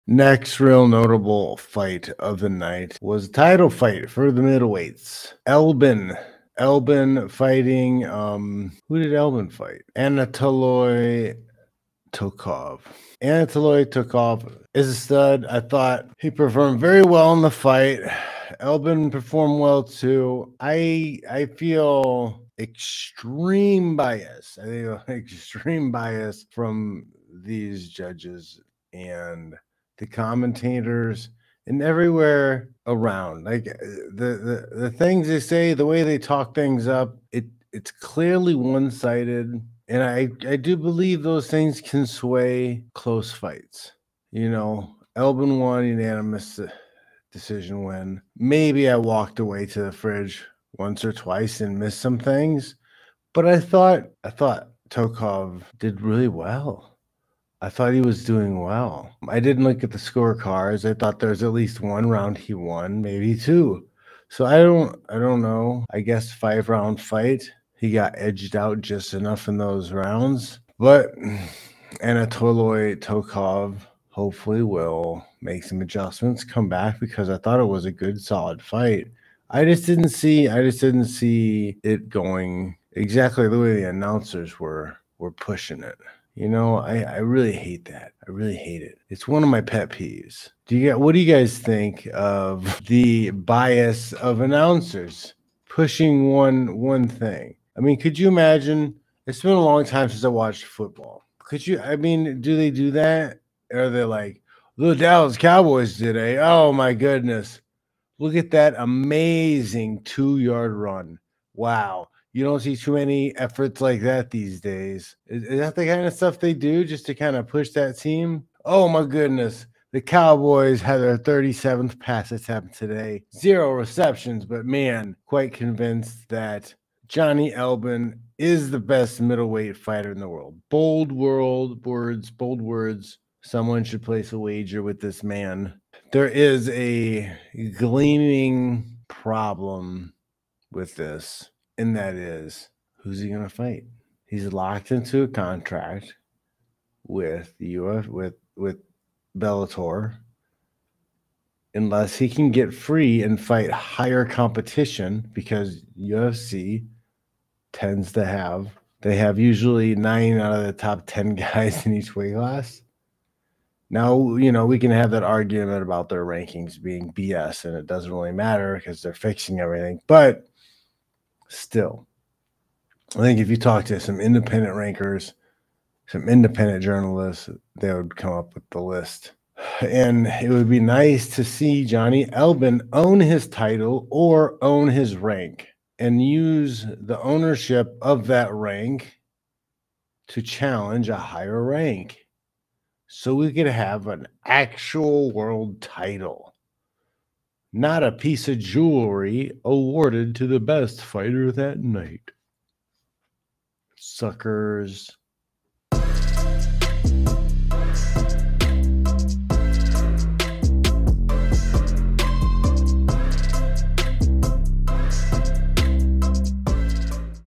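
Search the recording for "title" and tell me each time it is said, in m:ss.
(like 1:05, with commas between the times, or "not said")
0:03, 3:03, 3:15.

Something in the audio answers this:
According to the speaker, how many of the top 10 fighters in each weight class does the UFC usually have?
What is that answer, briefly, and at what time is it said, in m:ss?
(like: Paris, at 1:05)
9, at 2:39.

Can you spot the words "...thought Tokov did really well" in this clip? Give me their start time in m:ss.
0:54.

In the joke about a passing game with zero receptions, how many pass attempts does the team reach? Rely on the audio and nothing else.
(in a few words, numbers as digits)
37.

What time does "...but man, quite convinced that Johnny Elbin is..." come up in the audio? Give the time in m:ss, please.
2:04.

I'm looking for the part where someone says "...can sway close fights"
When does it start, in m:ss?
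0:41.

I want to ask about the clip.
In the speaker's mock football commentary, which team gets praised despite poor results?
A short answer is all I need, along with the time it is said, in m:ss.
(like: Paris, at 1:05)
Dallas Cowboys, at 1:44.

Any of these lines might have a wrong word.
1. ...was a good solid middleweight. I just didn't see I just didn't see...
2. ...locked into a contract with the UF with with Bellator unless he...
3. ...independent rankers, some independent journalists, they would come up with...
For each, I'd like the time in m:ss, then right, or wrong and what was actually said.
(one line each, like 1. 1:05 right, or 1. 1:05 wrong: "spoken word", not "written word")
1. 1:17 wrong: "fight", not "middleweight"
2. 2:24 right
3. 2:54 right.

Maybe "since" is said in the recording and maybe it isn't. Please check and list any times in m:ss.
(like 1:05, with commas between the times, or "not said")
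1:40.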